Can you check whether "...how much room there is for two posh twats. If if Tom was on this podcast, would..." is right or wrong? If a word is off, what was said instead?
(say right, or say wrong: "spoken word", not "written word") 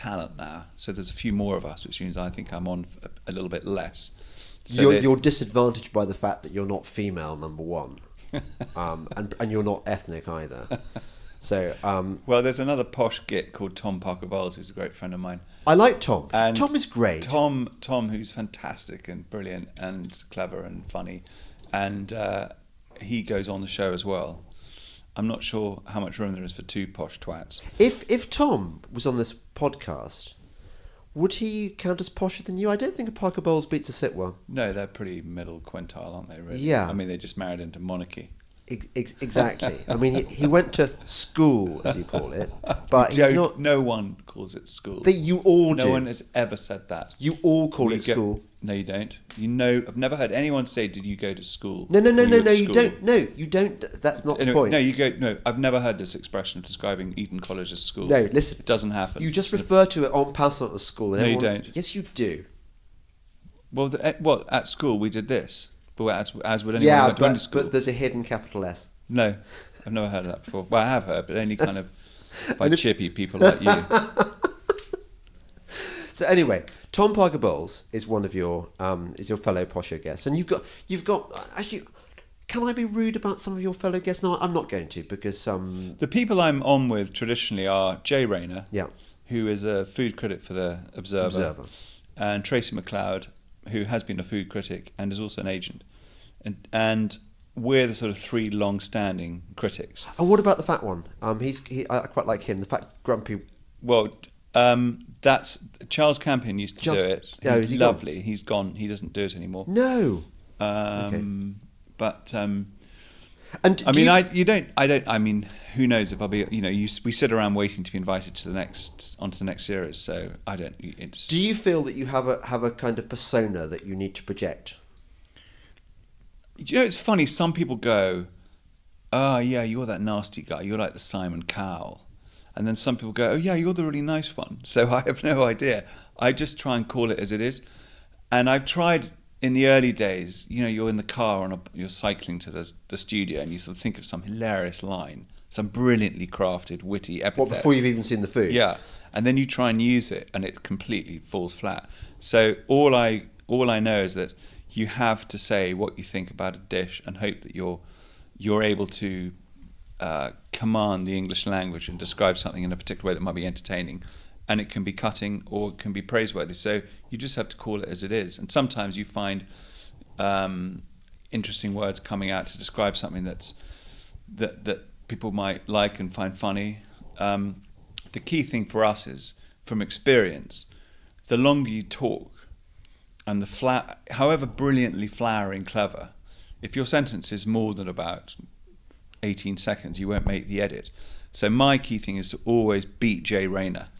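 right.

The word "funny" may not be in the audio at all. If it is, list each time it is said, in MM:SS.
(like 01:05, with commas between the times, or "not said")
00:20, 02:06, 02:56.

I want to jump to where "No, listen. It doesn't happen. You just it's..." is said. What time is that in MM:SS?
00:58.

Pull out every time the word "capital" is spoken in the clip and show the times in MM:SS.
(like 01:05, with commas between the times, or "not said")
01:08.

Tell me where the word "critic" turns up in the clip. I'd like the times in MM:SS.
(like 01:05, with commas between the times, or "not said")
01:30, 01:34, 01:39.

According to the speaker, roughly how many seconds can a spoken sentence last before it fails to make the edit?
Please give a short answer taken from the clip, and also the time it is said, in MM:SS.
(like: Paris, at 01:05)
18 seconds, at 03:09.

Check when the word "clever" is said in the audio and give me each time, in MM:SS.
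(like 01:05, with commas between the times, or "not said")
00:20, 03:05.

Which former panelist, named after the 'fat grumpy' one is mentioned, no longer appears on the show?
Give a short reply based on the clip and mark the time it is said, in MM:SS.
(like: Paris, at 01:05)
Charles Campion, at 01:45.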